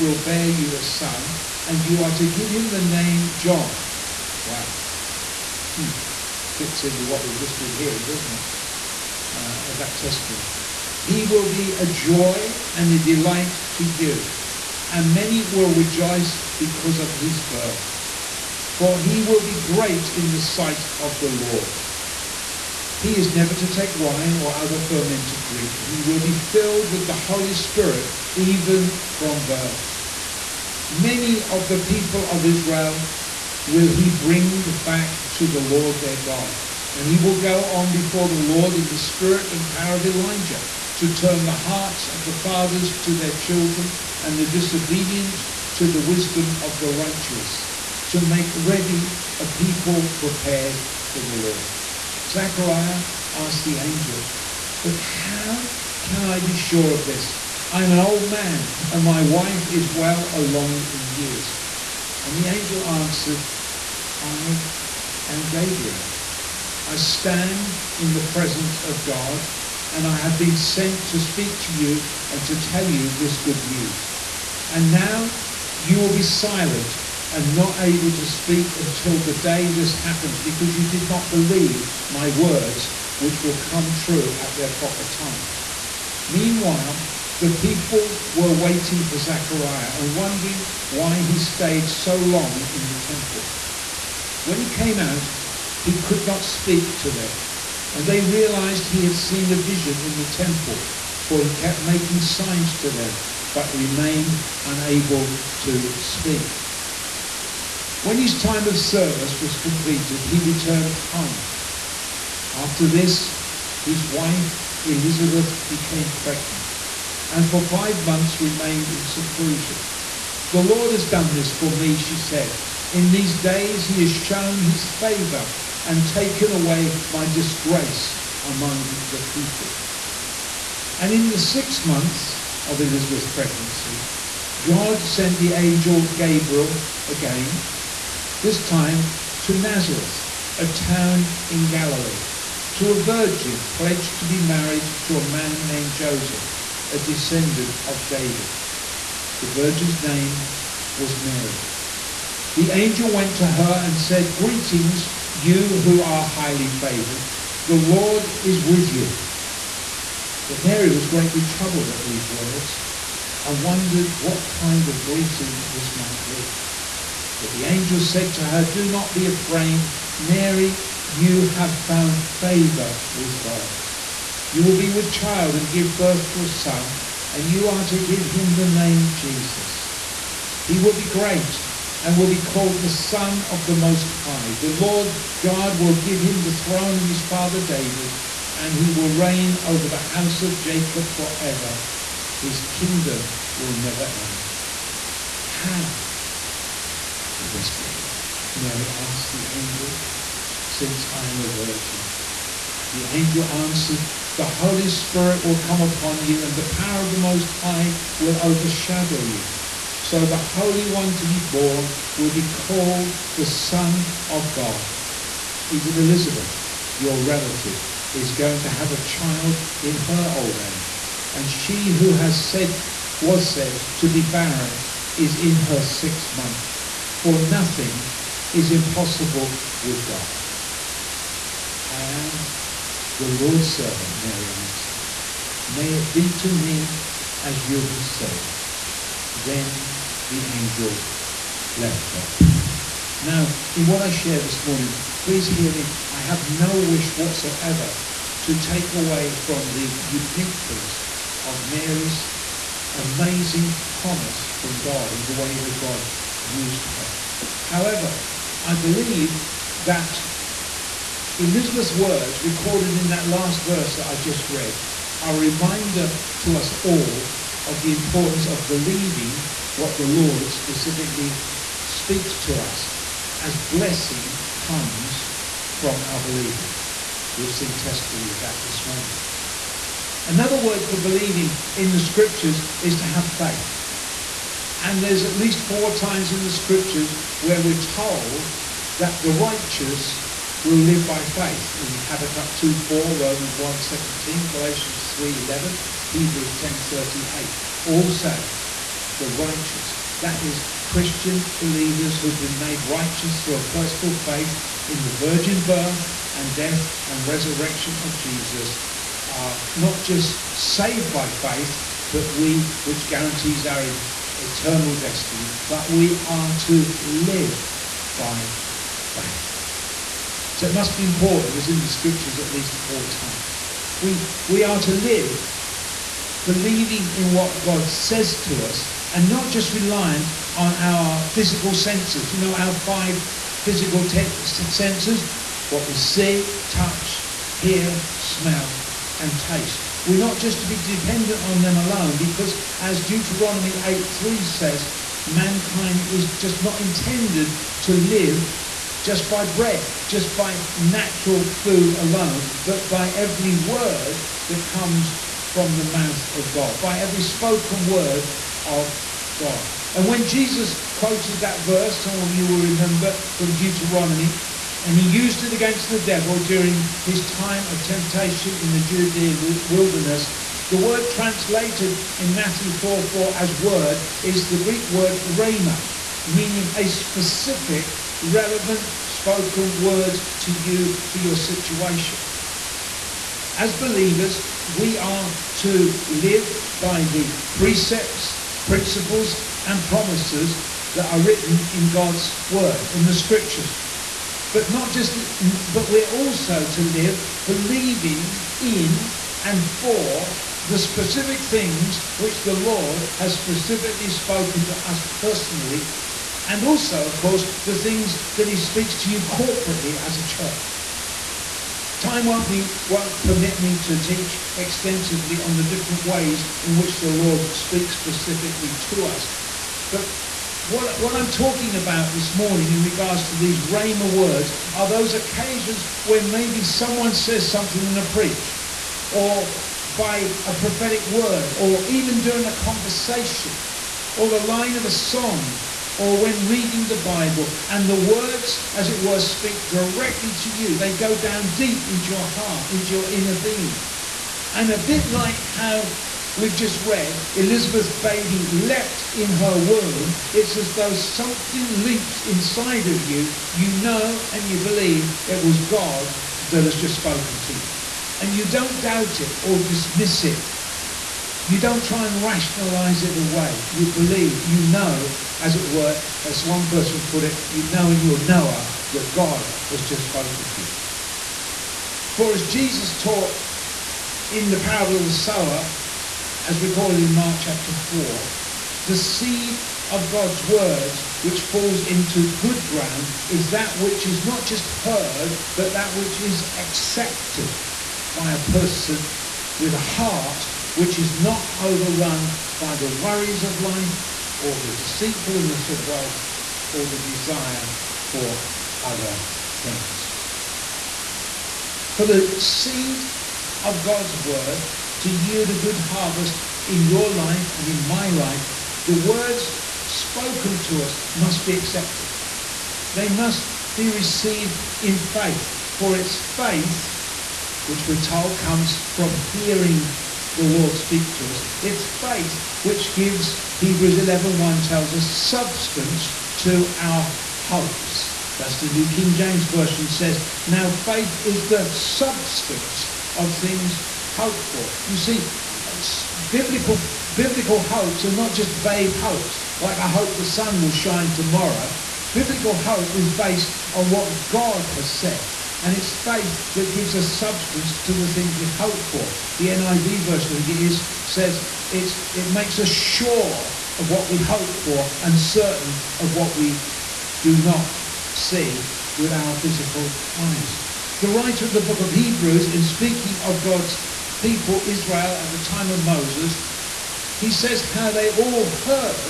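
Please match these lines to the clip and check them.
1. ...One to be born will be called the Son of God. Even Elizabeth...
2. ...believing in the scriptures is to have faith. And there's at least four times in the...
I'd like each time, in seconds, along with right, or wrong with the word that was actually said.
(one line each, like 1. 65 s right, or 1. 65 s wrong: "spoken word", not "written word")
1. 210 s right
2. 280 s right.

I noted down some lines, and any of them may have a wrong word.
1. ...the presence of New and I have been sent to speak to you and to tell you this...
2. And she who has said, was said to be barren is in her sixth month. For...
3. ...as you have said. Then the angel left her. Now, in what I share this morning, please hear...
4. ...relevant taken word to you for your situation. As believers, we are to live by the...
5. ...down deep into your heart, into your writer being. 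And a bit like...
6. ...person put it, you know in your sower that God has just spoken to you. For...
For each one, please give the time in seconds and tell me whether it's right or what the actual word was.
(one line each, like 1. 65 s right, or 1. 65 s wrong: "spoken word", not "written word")
1. 68 s wrong: "God", not "New"
2. 221 s right
3. 237 s right
4. 378 s wrong: "spoken", not "taken"
5. 441 s wrong: "inner", not "writer"
6. 466 s wrong: "knower", not "sower".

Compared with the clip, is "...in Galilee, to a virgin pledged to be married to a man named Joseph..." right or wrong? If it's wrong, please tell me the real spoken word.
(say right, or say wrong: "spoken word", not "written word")
right.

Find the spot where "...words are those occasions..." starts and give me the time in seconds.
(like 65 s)
424 s.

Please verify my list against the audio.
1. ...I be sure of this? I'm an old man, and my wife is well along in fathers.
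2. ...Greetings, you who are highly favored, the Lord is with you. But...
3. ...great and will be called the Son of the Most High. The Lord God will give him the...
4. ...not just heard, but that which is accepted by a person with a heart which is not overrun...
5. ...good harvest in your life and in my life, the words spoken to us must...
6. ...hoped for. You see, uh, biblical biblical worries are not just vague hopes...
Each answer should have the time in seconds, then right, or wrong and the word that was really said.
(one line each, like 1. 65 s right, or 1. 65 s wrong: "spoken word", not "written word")
1. 56 s wrong: "years", not "fathers"
2. 154 s right
3. 181 s right
4. 484 s right
5. 505 s right
6. 534 s wrong: "hopes", not "worries".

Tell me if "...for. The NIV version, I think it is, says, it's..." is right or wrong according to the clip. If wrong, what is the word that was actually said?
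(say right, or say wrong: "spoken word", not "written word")
right.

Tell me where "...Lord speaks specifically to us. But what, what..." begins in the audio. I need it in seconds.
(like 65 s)
417 s.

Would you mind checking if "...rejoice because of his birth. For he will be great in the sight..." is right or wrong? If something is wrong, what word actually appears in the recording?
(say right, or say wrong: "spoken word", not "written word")
right.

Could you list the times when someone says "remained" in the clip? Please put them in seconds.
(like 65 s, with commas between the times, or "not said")
103 s, 118 s.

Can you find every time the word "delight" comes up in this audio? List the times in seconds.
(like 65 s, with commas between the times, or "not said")
12 s.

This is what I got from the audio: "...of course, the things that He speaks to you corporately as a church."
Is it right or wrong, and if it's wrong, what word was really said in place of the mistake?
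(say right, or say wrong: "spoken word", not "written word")
right.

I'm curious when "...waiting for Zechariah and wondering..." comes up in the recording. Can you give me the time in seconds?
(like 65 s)
88 s.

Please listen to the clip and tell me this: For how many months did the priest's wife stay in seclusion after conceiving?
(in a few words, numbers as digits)
5.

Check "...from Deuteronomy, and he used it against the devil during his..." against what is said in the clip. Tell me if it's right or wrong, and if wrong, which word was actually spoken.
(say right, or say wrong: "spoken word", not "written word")
right.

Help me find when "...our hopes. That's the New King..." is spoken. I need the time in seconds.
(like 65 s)
526 s.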